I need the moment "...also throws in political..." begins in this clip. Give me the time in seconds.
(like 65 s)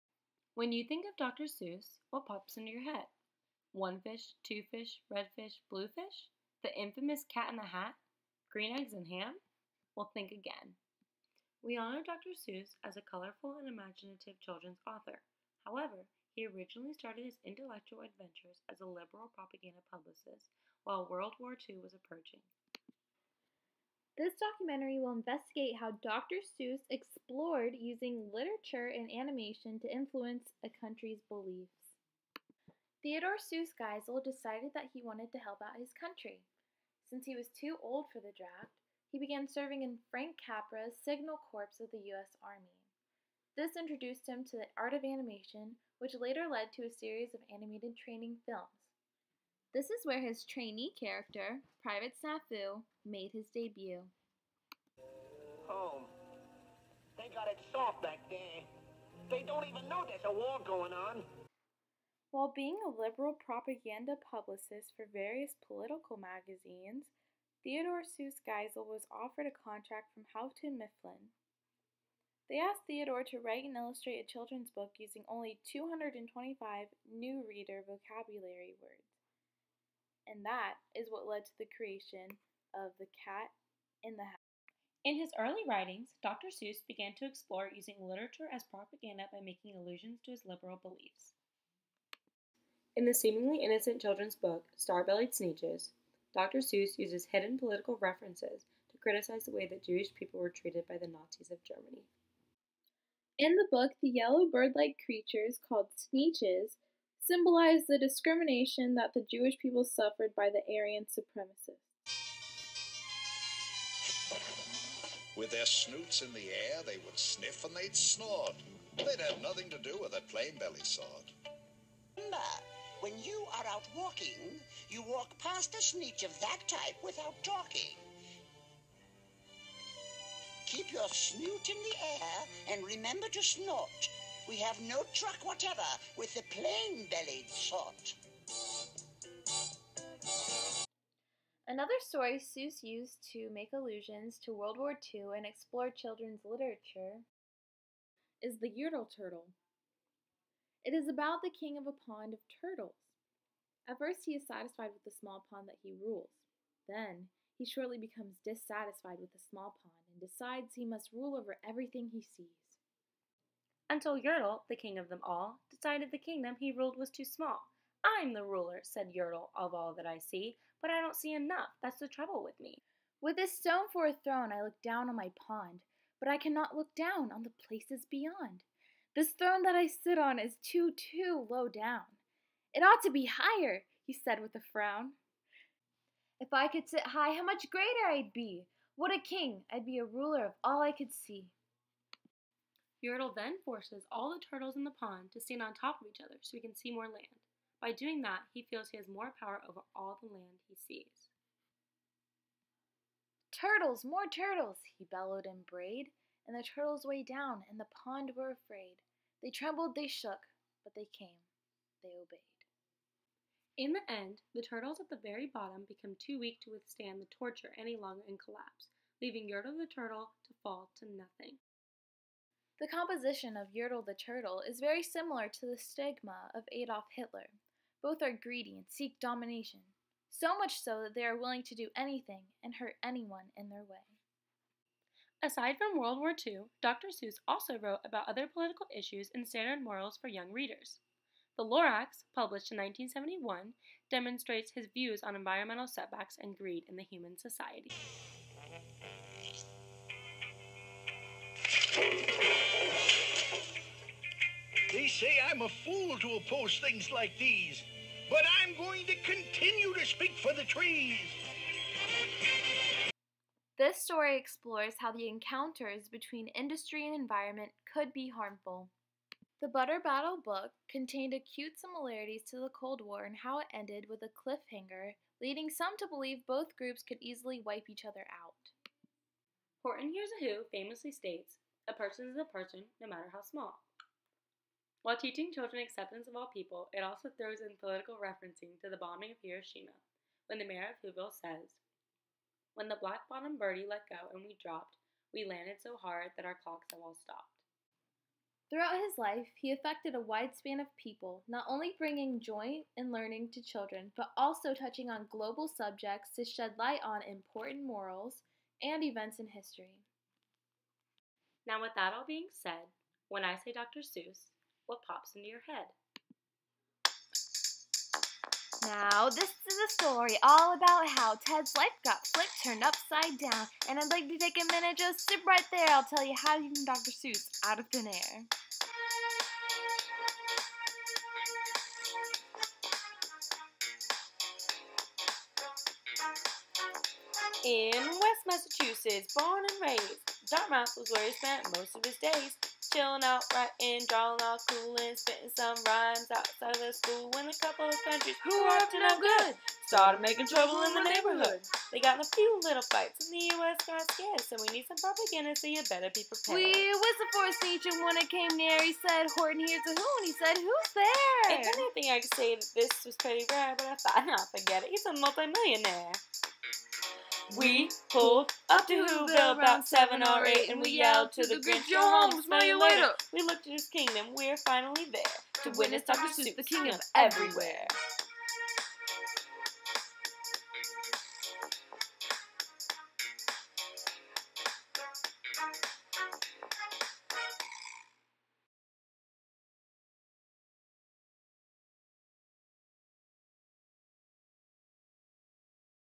287 s.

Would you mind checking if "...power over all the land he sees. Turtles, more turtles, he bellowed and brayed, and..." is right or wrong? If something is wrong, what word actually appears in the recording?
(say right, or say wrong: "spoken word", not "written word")
right.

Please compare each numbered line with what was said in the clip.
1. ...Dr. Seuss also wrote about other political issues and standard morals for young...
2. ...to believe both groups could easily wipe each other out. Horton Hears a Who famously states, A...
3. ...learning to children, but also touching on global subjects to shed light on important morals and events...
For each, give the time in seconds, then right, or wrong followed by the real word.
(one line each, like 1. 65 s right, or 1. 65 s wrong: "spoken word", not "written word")
1. 236 s right
2. 275 s right
3. 303 s right.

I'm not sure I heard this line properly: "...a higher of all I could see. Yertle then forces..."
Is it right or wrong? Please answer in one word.
wrong.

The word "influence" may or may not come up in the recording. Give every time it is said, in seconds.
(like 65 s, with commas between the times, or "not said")
29 s.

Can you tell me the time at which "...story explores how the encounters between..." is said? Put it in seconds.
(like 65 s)
263 s.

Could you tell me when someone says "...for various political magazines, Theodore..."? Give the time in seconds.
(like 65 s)
64 s.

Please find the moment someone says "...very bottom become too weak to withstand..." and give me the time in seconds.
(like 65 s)
215 s.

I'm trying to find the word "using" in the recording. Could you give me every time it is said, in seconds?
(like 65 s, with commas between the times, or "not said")
27 s, 74 s, 87 s.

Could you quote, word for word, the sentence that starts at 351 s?
They got in a few little fights, and the U.S.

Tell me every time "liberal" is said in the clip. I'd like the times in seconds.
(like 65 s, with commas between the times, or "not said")
18 s, 62 s, 90 s.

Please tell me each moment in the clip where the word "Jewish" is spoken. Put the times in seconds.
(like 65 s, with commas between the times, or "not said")
99 s, 109 s.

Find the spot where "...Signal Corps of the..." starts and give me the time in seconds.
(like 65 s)
41 s.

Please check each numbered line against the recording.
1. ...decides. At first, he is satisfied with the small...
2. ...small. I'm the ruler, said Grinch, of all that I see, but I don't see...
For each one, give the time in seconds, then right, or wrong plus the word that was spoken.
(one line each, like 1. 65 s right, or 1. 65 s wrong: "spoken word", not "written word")
1. 152 s wrong: "turtles", not "decides"
2. 167 s wrong: "Yertle", not "Grinch".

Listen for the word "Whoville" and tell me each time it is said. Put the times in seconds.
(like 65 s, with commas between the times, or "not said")
291 s, 369 s.